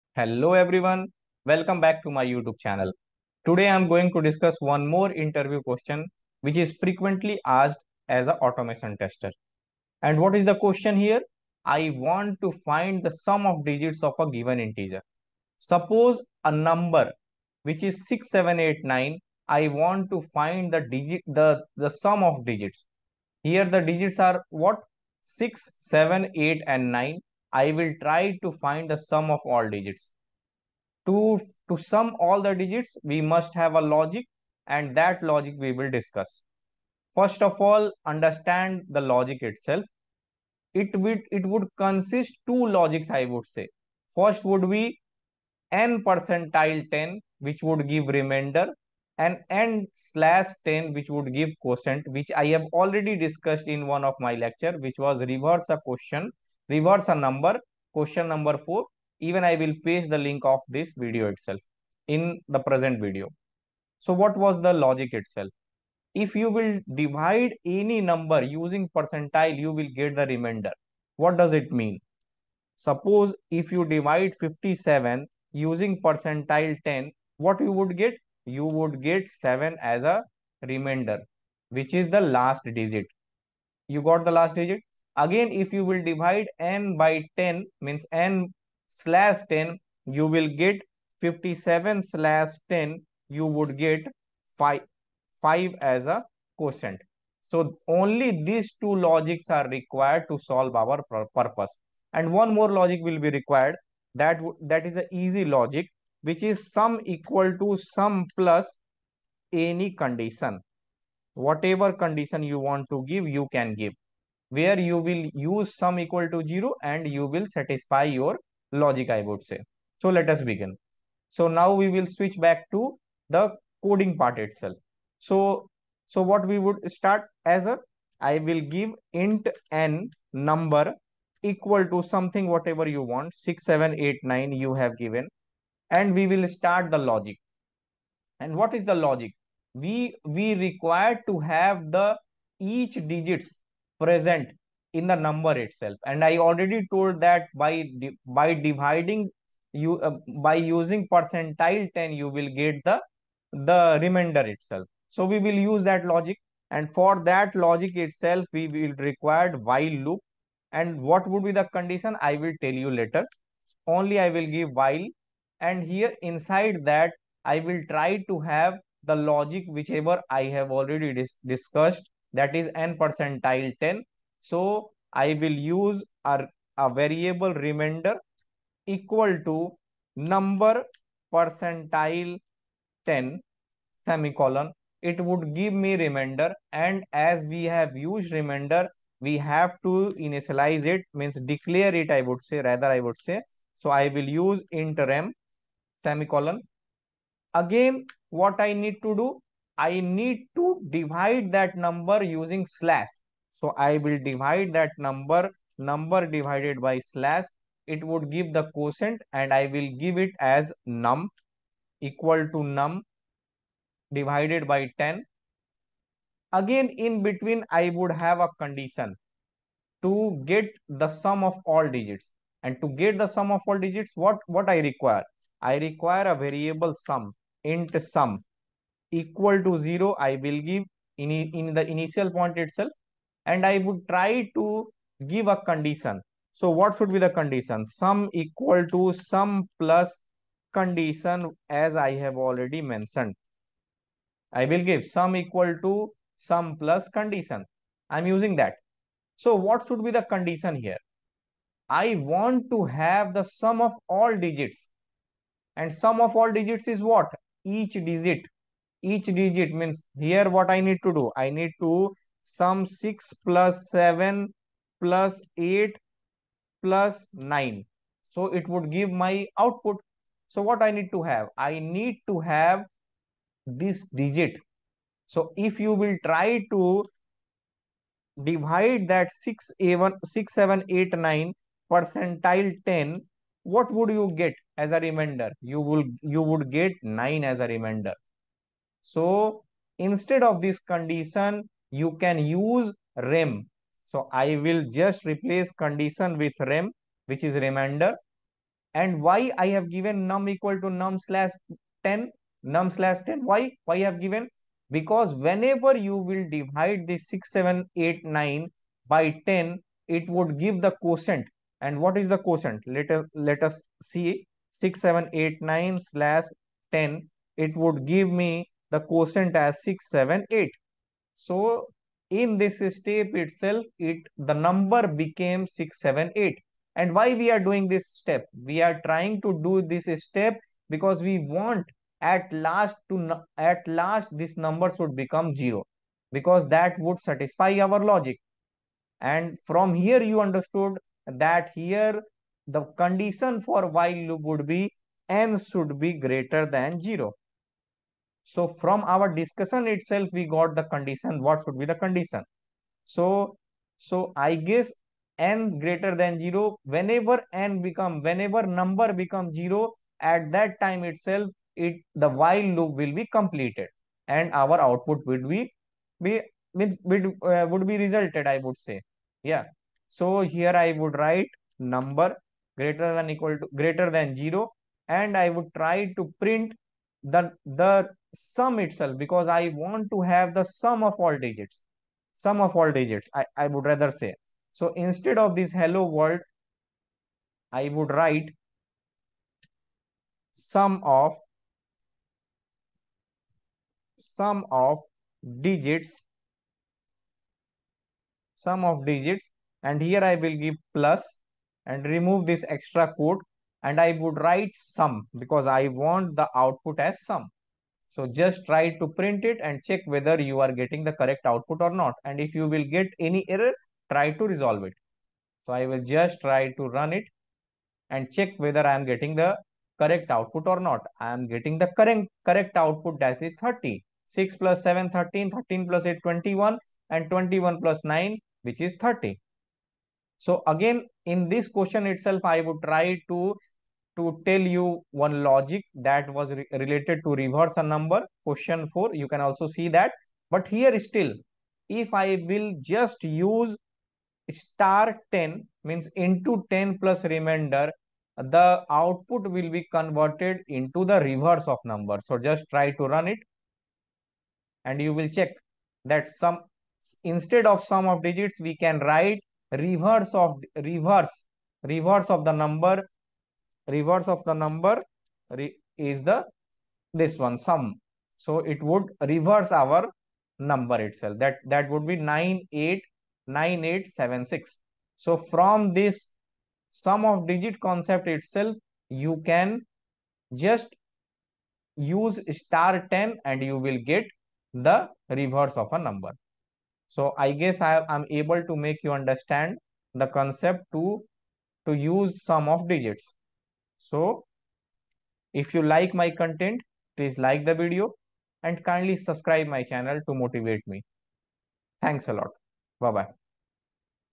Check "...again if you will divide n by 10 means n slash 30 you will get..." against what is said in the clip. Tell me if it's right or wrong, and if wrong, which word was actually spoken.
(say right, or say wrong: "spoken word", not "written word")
wrong: "10", not "30".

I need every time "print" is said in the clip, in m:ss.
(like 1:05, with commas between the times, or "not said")
6:16, 6:49.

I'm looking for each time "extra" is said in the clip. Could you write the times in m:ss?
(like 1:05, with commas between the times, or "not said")
6:42.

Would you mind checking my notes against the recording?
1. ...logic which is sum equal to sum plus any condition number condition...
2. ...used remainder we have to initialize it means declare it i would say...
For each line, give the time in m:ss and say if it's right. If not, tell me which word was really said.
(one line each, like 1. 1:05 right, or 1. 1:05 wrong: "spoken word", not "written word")
1. 1:45 wrong: "whatever", not "number"
2. 3:07 right.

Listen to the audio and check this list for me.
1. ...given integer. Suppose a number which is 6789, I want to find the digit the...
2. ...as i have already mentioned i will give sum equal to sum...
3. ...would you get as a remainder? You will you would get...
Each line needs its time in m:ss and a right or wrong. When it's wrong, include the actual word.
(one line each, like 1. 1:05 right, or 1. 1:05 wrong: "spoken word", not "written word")
1. 0:14 right
2. 4:01 right
3. 4:43 right.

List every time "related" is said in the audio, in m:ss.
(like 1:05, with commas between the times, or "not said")
7:16.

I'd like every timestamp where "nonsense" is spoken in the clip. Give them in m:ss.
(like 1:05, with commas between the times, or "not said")
not said.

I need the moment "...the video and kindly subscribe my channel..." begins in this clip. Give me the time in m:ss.
8:17.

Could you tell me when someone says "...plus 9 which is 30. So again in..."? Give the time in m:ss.
7:07.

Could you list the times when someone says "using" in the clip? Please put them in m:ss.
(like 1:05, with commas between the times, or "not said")
1:08, 1:15, 2:30, 3:22, 4:08.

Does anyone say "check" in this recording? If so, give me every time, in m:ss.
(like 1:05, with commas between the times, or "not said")
6:49, 6:58, 7:35.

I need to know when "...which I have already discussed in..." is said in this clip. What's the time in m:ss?
0:52.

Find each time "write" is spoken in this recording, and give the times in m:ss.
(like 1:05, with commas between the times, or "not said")
6:11, 6:28, 6:44, 7:38.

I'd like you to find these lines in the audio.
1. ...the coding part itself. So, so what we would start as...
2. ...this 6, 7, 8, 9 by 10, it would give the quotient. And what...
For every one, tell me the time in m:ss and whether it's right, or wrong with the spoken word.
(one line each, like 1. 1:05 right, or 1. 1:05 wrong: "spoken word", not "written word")
1. 2:03 right
2. 5:07 right.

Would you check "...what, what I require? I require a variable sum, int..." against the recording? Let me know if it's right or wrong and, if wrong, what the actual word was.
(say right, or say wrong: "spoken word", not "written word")
right.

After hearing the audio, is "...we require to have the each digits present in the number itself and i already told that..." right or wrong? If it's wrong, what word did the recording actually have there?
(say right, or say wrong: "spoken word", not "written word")
right.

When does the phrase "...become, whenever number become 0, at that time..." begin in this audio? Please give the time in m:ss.
5:57.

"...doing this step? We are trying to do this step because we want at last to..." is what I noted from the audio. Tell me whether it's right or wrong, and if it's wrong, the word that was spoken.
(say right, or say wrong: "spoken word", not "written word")
right.